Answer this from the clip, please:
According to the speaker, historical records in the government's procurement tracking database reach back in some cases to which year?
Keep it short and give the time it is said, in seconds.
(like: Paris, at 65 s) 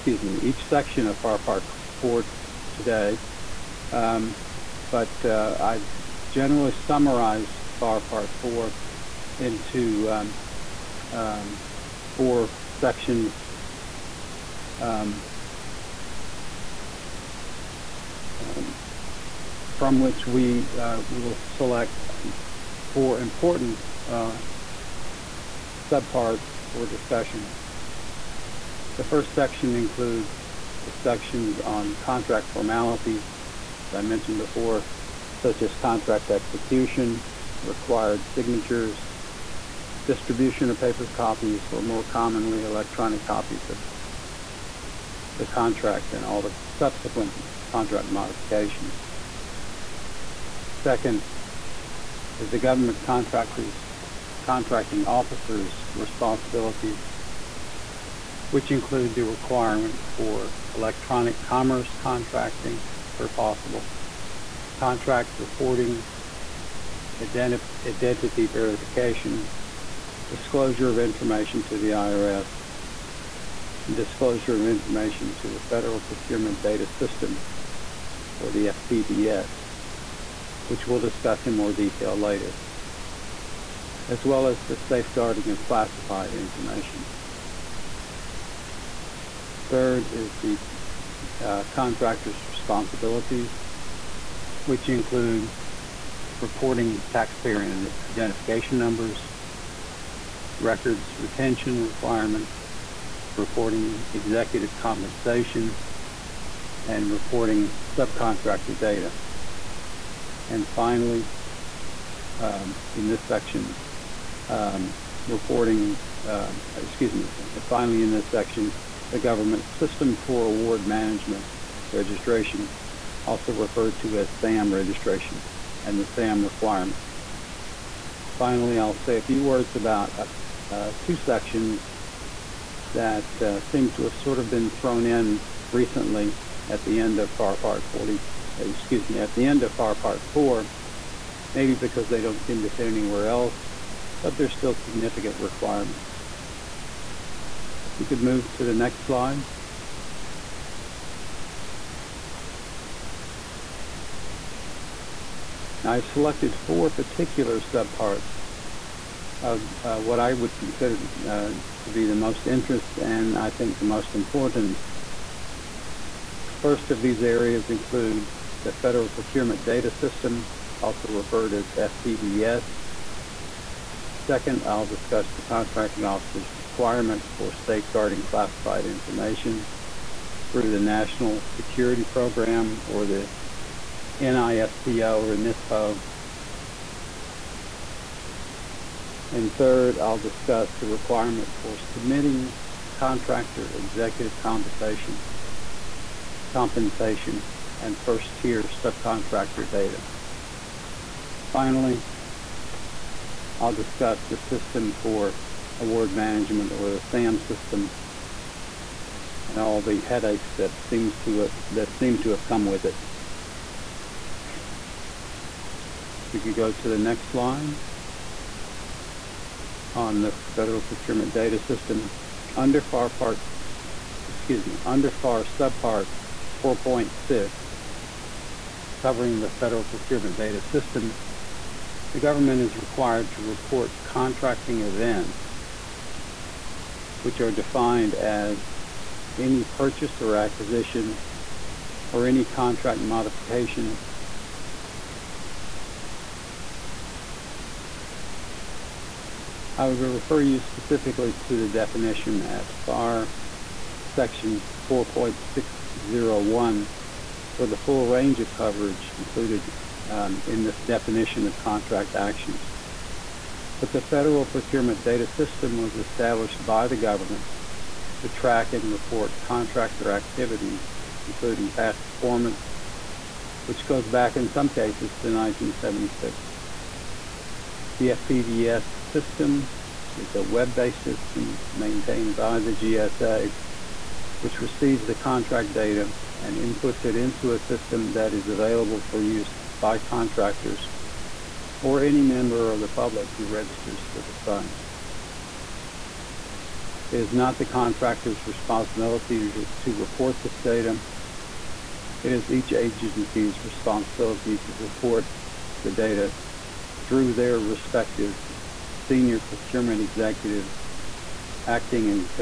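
1976, at 275 s.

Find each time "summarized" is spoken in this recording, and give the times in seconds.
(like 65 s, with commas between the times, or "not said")
6 s.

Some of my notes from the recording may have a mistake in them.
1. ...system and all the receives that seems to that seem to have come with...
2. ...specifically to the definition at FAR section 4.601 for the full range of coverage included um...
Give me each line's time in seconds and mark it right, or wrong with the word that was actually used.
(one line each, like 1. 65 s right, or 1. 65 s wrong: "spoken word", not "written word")
1. 207 s wrong: "headaches", not "receives"
2. 250 s right.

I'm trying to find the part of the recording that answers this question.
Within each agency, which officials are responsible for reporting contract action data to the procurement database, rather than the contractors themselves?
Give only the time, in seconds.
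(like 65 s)
309 s.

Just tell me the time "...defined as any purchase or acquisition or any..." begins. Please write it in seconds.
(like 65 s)
237 s.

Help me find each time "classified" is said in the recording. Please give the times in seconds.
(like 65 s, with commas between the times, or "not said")
85 s, 178 s.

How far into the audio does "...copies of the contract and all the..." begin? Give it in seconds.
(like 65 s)
43 s.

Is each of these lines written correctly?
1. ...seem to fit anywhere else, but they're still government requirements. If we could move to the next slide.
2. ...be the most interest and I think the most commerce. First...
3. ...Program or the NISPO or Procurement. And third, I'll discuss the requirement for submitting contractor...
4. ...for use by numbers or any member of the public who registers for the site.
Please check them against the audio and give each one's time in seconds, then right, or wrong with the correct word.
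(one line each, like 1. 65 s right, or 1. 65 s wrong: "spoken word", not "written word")
1. 142 s wrong: "significant", not "government"
2. 161 s wrong: "importance", not "commerce"
3. 182 s wrong: "NISPO", not "Procurement"
4. 289 s wrong: "contractors", not "numbers".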